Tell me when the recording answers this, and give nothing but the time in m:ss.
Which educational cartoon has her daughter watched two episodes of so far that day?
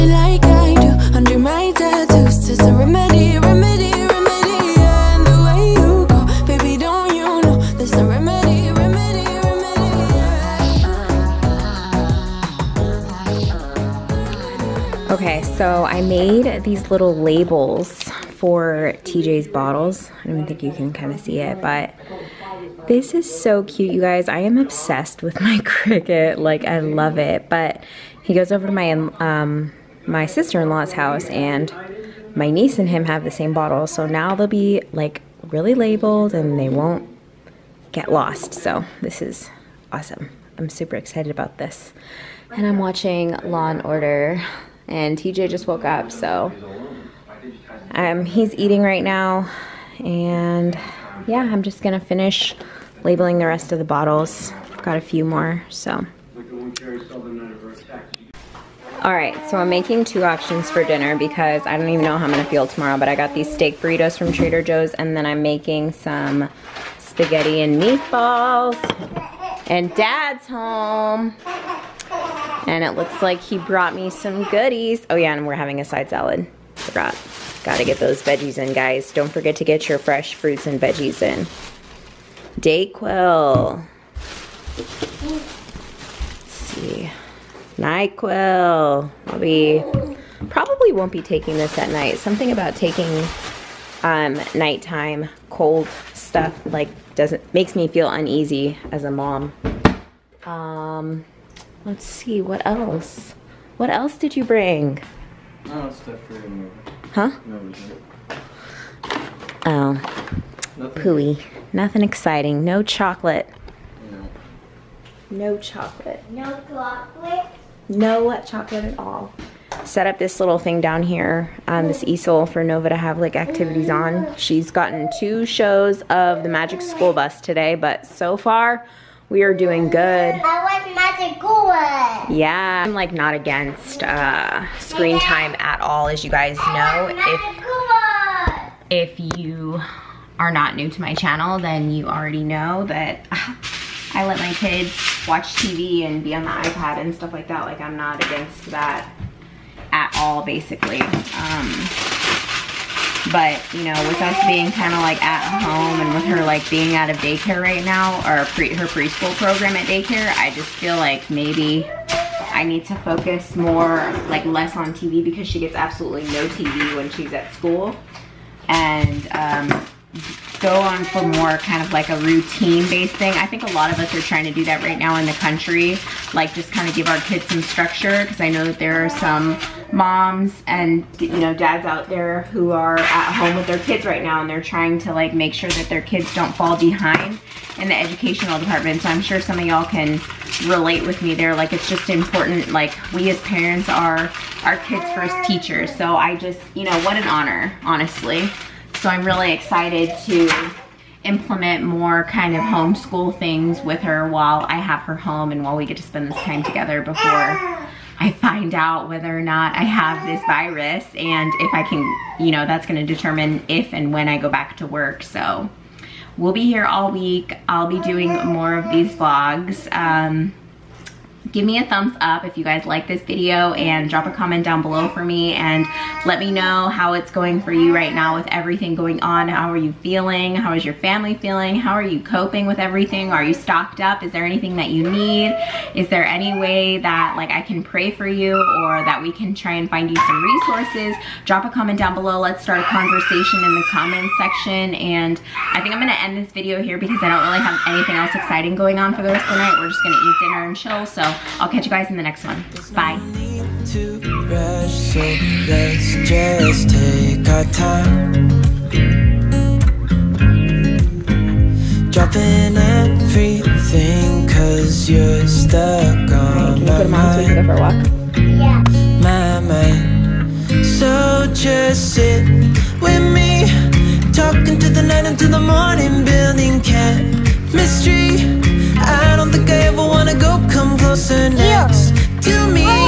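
2:06.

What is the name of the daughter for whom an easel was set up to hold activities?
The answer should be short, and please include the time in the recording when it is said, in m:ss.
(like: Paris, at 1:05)
Nova, at 2:02.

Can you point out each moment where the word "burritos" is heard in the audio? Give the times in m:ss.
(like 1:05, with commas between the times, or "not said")
1:03.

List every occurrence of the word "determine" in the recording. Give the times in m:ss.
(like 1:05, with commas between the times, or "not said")
3:33.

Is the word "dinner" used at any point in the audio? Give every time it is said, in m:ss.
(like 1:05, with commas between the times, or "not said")
1:00, 4:10.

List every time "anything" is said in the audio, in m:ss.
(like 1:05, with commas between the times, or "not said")
3:54, 4:07.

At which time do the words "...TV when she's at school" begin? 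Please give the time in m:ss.
2:46.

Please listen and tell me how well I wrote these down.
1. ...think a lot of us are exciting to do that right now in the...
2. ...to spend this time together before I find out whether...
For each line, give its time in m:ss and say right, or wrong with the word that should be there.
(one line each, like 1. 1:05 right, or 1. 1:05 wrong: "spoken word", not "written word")
1. 2:53 wrong: "trying", not "exciting"
2. 3:25 right.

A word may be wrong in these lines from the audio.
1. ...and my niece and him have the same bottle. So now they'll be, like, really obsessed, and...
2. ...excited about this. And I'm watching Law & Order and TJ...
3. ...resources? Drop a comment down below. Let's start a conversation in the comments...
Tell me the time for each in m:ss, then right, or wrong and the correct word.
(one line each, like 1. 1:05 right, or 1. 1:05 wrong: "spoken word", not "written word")
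1. 0:31 wrong: "labeled", not "obsessed"
2. 0:40 right
3. 4:00 right.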